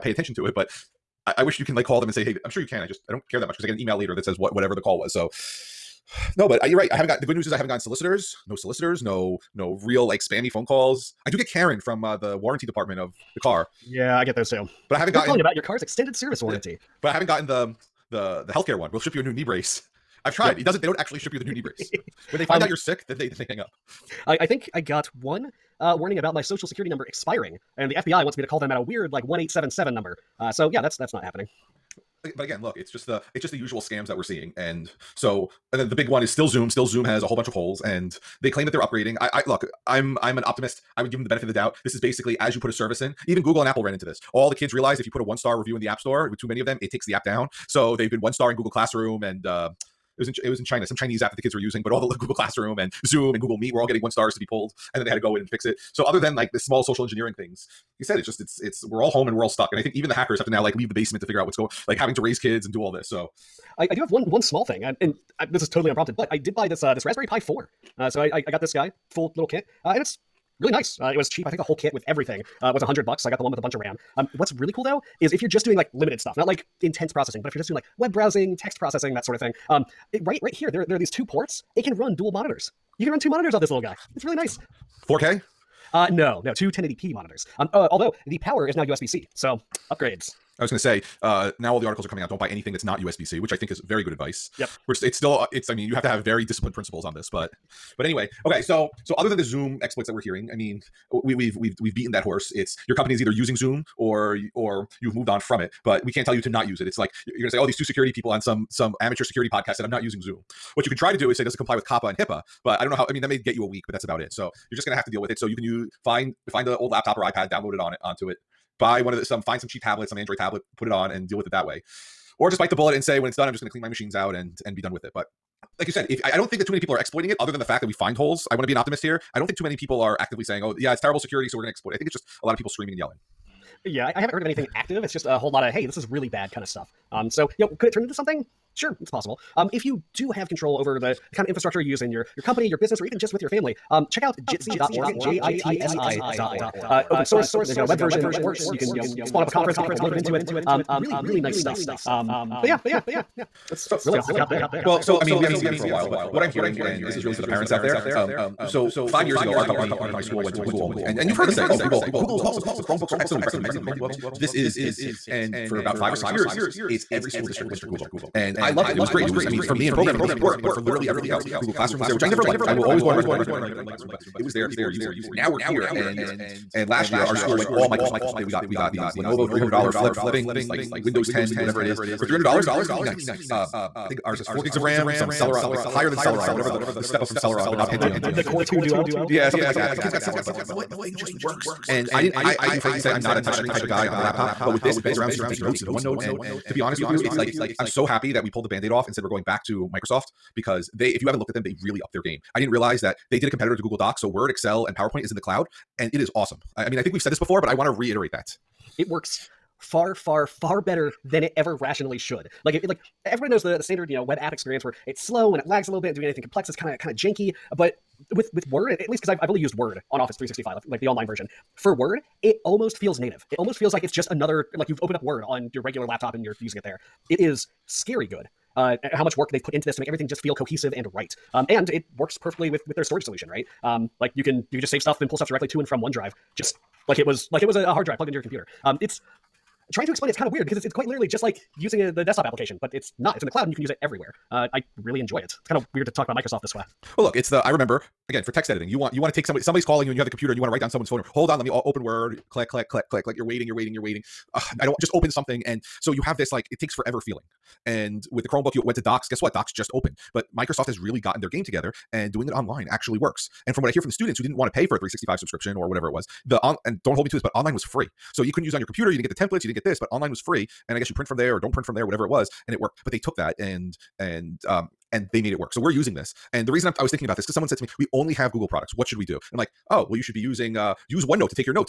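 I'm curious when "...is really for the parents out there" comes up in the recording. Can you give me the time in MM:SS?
02:37.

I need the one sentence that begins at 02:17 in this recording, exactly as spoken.
Um, so you know, could it turn into something?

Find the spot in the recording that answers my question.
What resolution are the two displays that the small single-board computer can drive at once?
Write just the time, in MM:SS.
01:26.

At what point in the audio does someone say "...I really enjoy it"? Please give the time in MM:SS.
04:04.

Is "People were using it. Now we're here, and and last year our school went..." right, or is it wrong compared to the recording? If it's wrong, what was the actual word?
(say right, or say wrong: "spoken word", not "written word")
right.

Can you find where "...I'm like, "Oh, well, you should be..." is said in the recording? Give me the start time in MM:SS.
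04:39.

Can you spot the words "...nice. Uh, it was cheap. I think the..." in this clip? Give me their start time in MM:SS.
01:10.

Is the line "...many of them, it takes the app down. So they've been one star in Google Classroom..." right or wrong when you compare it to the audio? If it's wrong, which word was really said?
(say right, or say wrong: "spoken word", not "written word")
right.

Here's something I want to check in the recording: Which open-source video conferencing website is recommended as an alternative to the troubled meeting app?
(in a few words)
jitsi.org.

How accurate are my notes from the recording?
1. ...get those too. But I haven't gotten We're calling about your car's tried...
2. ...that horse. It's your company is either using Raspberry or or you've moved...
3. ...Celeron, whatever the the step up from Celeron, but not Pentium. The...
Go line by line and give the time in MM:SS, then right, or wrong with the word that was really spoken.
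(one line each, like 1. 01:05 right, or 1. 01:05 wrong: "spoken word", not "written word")
1. 00:14 wrong: "extended", not "tried"
2. 01:42 wrong: "Zoom", not "Raspberry"
3. 03:06 right.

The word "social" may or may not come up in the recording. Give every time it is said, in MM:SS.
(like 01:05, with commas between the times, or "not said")
00:26, 00:56.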